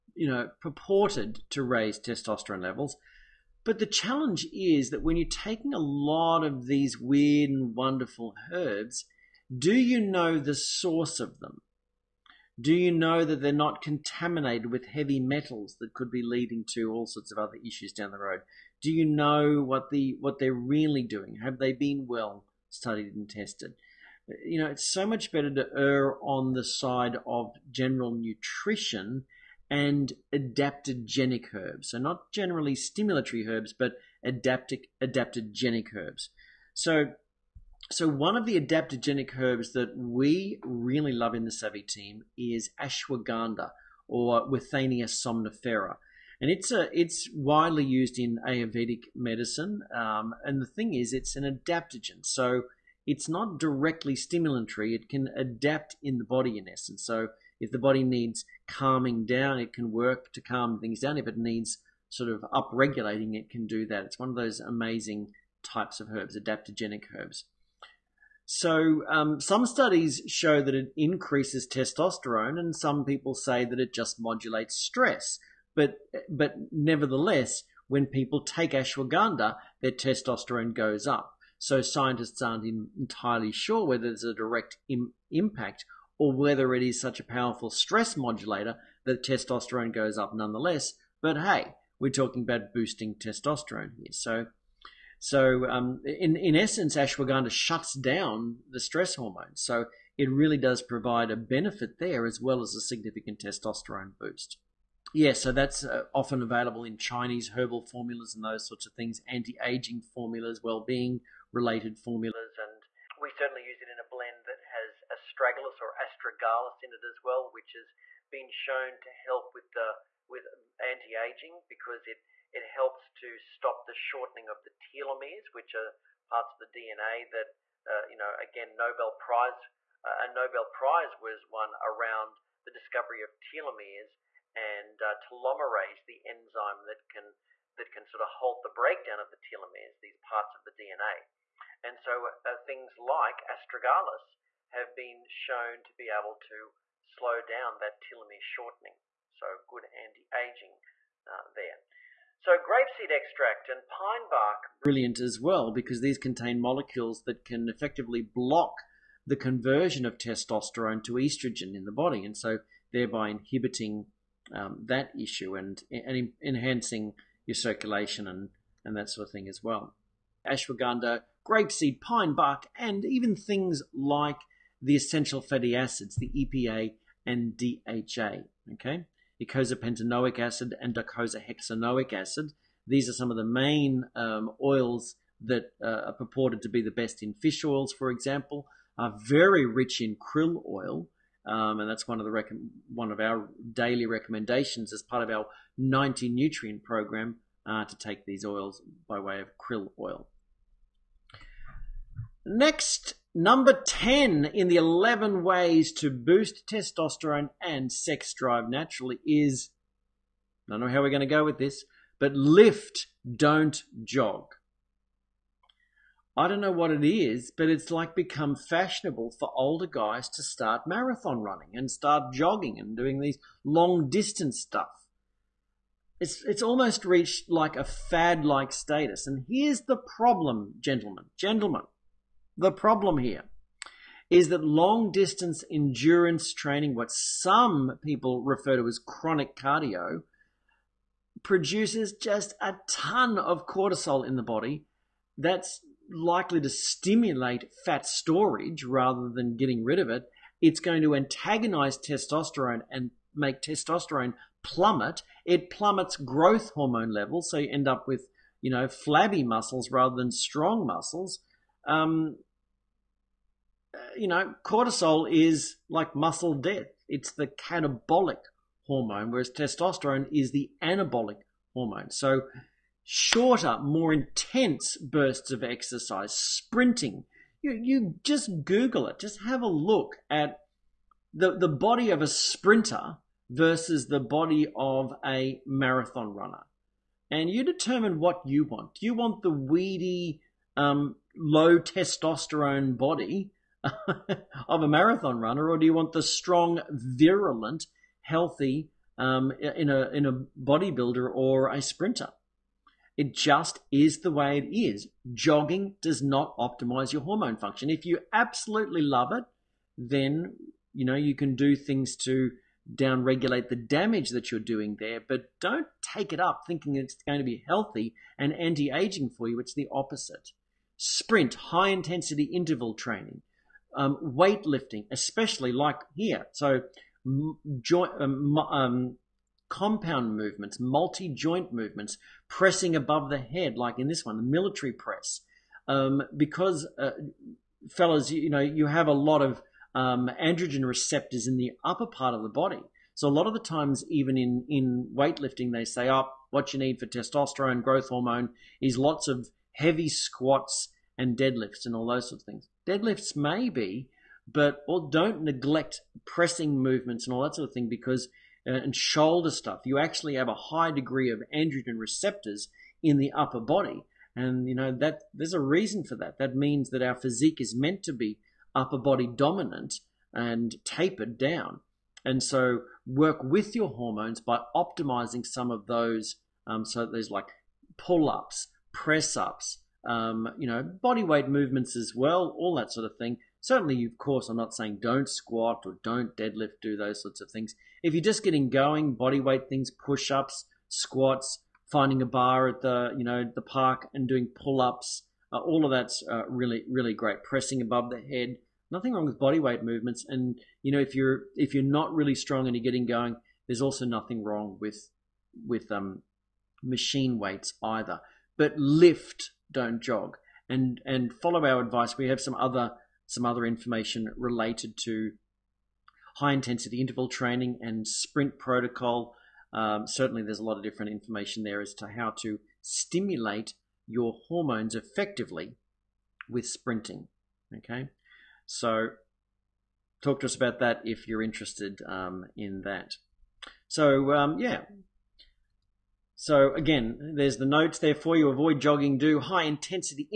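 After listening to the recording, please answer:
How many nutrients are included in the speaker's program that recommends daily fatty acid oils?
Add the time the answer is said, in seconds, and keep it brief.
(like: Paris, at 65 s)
90, at 195 s.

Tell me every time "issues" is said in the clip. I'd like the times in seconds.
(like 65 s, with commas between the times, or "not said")
17 s, 165 s.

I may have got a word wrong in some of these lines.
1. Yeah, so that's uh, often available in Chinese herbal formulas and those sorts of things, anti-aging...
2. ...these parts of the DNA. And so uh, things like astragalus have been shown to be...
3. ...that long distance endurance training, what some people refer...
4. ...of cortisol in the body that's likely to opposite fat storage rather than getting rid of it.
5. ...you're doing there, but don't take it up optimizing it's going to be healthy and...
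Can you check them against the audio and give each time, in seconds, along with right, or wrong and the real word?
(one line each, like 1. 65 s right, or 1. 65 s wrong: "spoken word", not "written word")
1. 105 s right
2. 140 s right
3. 234 s right
4. 243 s wrong: "stimulate", not "opposite"
5. 314 s wrong: "thinking", not "optimizing".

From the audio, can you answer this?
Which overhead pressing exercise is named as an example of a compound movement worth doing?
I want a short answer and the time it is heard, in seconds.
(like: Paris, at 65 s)
Military press, at 334 s.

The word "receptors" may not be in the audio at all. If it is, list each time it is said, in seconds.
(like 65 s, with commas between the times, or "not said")
340 s, 361 s.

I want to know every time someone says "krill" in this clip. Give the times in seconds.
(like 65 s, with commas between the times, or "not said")
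190 s, 199 s.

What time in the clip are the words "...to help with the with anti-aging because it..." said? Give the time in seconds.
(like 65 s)
118 s.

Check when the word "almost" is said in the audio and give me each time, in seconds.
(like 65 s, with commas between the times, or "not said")
226 s.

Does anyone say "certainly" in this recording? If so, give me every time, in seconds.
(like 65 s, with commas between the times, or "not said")
113 s, 383 s, 420 s.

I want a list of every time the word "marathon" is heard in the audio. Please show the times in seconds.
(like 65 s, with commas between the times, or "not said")
220 s, 285 s, 294 s.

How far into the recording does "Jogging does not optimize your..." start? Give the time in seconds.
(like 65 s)
305 s.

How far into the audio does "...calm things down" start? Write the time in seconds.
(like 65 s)
60 s.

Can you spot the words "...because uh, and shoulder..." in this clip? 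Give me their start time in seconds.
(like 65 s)
357 s.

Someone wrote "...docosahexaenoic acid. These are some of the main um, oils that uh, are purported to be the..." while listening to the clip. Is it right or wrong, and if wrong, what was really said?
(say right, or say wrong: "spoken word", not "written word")
right.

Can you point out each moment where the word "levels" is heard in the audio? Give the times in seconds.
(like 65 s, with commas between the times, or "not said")
2 s, 257 s.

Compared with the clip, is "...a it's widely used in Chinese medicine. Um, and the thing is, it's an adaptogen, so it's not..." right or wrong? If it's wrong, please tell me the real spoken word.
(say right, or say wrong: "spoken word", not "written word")
wrong: "Ayurvedic", not "Chinese".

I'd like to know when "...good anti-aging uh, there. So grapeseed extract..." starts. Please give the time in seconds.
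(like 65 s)
149 s.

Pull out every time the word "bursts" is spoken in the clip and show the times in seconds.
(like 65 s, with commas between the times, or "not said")
274 s.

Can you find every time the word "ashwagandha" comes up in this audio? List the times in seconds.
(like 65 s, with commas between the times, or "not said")
42 s, 78 s, 96 s, 170 s.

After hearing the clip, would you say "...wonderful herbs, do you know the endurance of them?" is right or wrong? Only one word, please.
wrong.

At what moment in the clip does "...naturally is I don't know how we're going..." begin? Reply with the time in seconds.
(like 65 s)
208 s.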